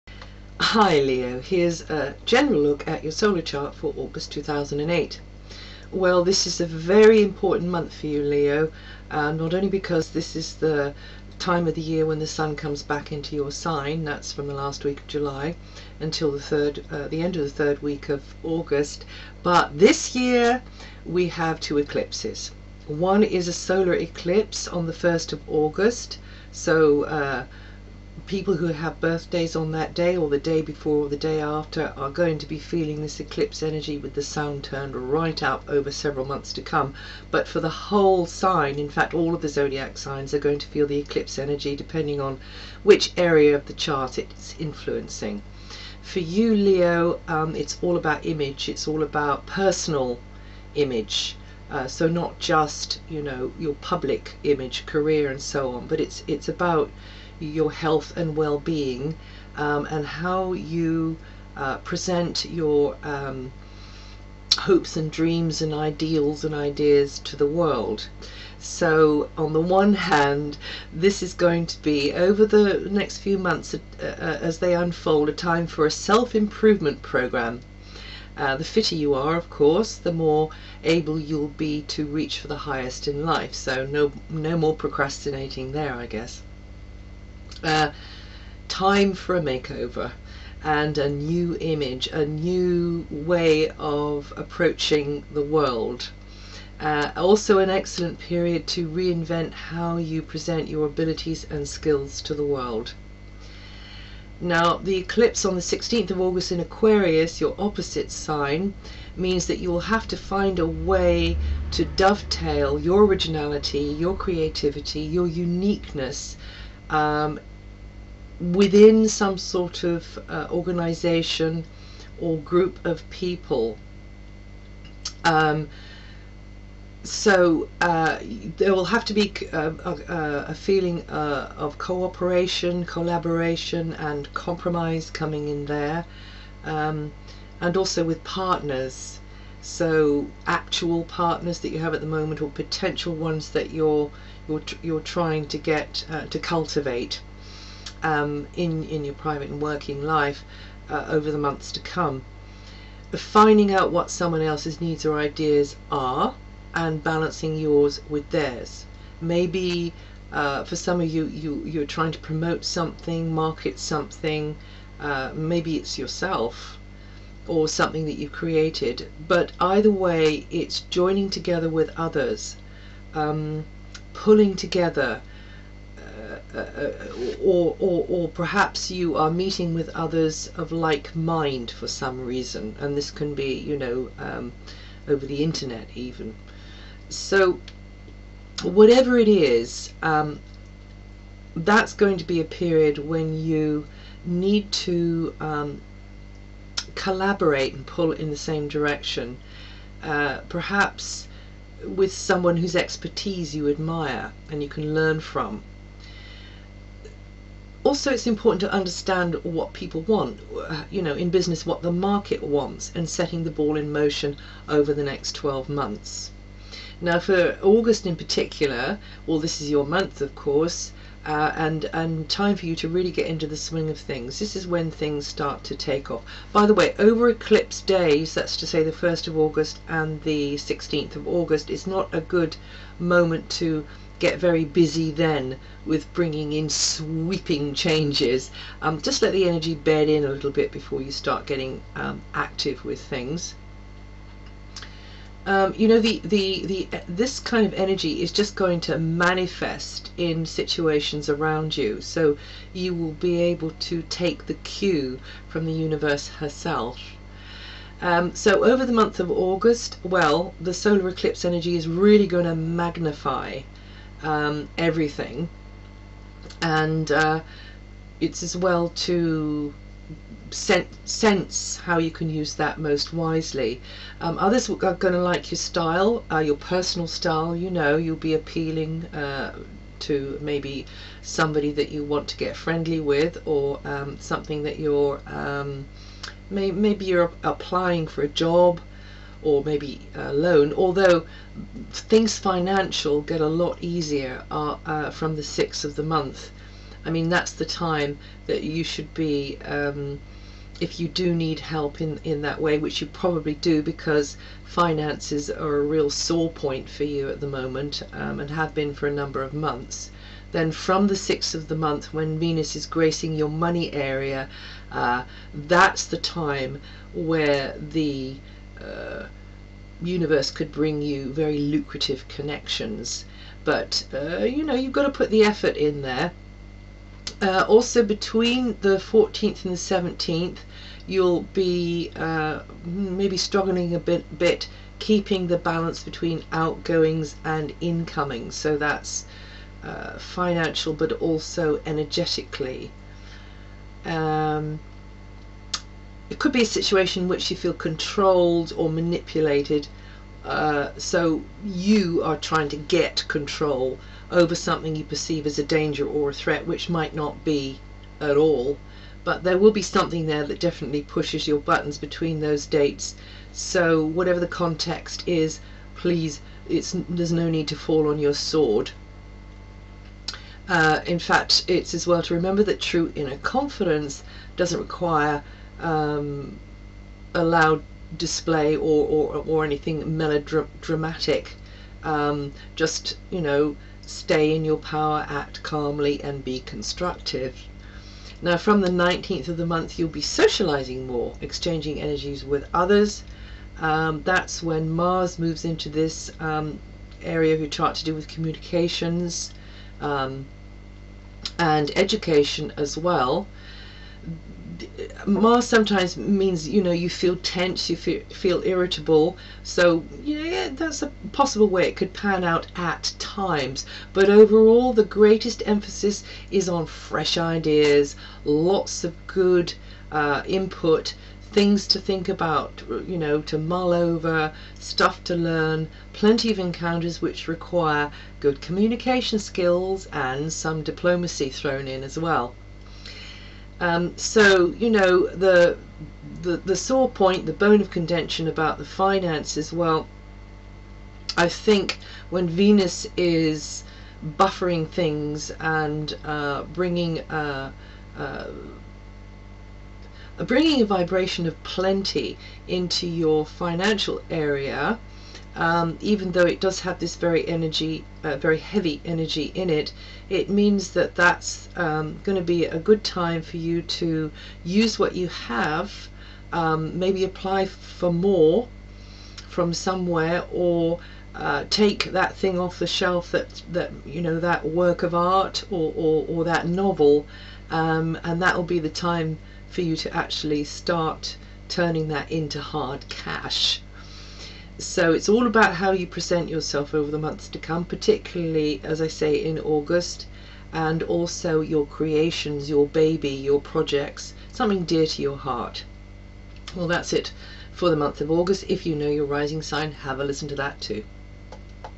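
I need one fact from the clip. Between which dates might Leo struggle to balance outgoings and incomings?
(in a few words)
14th to 17th.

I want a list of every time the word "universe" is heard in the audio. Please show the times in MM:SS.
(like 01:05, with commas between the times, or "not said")
04:15, 05:20.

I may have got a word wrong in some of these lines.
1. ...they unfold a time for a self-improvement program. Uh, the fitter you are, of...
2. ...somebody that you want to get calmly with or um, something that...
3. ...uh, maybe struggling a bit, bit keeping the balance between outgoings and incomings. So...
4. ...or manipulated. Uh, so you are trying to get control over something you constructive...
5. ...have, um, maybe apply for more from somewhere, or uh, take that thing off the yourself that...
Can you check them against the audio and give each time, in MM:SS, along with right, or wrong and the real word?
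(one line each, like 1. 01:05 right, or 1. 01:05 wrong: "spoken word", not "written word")
1. 01:14 right
2. 04:41 wrong: "friendly", not "calmly"
3. 05:32 right
4. 05:48 wrong: "perceive", not "constructive"
5. 07:45 wrong: "shelf", not "yourself".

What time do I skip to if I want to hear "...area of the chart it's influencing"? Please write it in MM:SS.
00:43.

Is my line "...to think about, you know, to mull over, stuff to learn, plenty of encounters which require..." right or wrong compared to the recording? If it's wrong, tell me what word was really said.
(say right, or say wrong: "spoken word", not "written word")
right.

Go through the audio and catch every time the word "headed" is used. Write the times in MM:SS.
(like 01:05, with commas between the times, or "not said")
not said.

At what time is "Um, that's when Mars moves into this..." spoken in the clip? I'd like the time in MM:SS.
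06:33.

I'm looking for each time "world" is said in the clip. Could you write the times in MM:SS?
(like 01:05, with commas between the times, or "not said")
01:07, 01:35, 01:42.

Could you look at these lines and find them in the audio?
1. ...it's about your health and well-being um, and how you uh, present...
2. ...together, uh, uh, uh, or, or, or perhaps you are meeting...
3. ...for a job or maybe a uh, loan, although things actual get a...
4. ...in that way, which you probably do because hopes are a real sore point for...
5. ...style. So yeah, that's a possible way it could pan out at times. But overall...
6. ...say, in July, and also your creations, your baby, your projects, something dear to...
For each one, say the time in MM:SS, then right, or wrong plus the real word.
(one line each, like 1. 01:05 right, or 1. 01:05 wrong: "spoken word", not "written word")
1. 00:56 right
2. 02:54 right
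3. 04:48 wrong: "financial", not "actual"
4. 05:02 wrong: "finances", not "hopes"
5. 06:48 wrong: "irritable", not "style"
6. 08:09 wrong: "August", not "July".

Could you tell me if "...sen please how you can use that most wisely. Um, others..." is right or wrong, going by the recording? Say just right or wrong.
wrong.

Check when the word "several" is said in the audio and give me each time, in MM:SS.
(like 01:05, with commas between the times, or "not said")
00:35.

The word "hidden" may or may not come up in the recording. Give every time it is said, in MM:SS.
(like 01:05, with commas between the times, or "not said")
not said.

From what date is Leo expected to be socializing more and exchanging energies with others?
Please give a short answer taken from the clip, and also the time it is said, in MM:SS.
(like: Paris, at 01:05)
19th, at 06:28.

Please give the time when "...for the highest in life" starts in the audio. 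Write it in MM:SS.
01:22.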